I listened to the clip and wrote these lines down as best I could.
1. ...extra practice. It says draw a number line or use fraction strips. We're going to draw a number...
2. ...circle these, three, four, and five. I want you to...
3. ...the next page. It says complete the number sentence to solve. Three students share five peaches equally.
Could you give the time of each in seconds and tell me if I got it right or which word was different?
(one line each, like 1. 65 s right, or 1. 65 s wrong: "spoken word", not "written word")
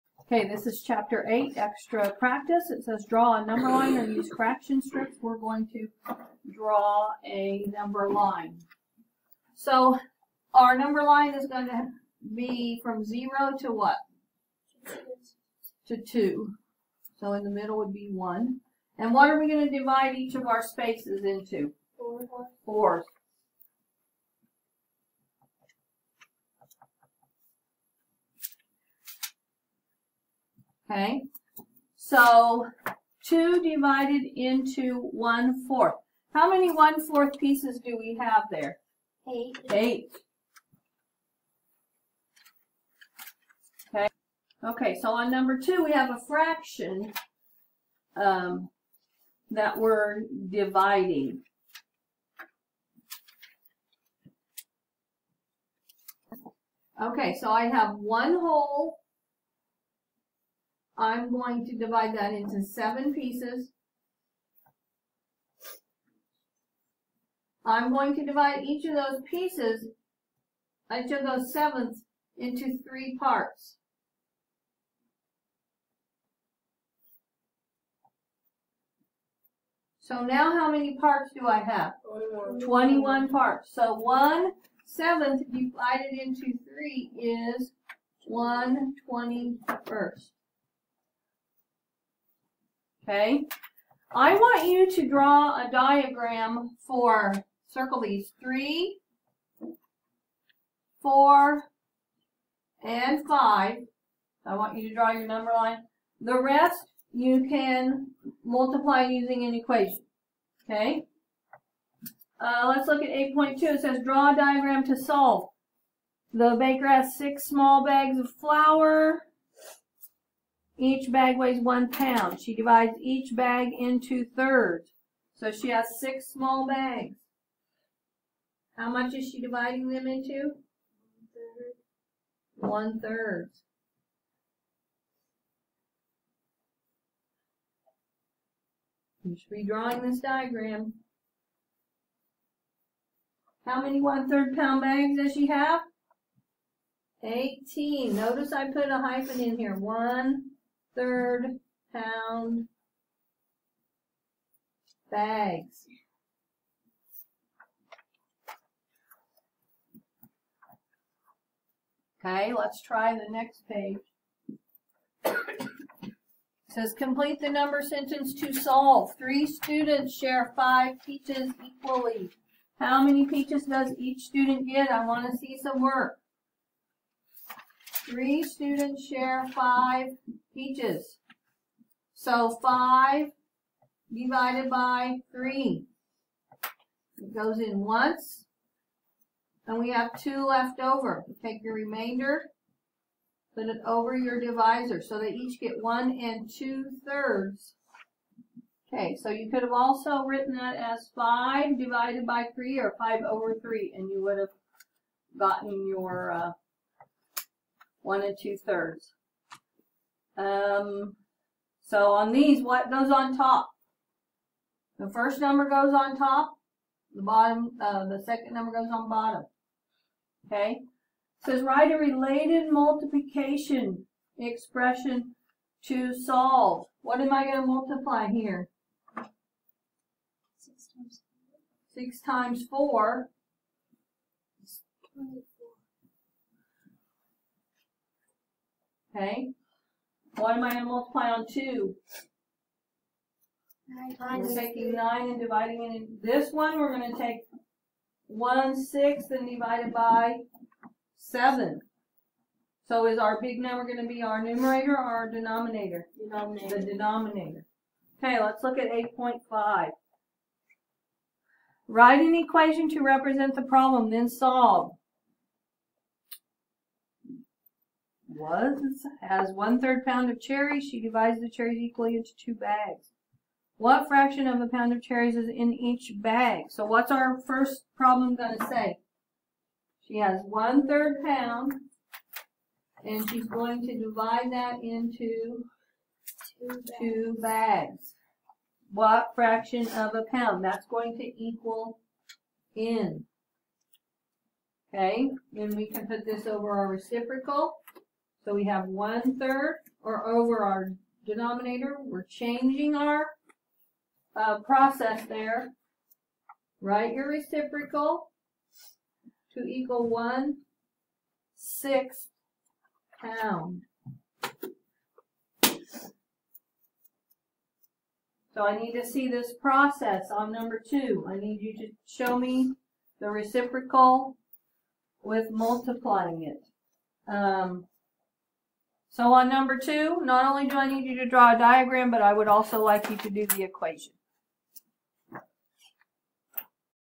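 1. 1 s right
2. 97 s right
3. 163 s right.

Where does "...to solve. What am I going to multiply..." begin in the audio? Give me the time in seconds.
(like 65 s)
225 s.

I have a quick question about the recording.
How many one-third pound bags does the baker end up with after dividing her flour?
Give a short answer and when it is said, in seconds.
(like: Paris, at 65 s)
18, at 147 s.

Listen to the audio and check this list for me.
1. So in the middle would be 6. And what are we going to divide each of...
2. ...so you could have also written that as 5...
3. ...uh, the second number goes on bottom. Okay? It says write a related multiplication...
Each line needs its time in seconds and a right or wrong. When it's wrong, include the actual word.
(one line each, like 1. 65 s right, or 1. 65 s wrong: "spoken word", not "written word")
1. 17 s wrong: "1", not "6"
2. 199 s right
3. 217 s right.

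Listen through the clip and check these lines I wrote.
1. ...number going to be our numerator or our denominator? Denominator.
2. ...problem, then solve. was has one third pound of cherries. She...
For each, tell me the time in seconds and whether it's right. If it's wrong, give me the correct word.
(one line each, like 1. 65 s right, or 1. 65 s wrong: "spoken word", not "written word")
1. 253 s right
2. 263 s right.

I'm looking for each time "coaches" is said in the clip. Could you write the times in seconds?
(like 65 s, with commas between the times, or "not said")
not said.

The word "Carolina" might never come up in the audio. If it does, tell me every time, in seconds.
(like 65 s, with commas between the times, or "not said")
not said.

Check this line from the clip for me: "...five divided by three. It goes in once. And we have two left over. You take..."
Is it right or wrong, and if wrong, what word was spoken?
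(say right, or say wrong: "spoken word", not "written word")
right.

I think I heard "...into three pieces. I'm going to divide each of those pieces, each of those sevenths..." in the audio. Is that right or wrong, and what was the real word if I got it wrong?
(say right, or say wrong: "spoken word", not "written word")
wrong: "seven", not "three".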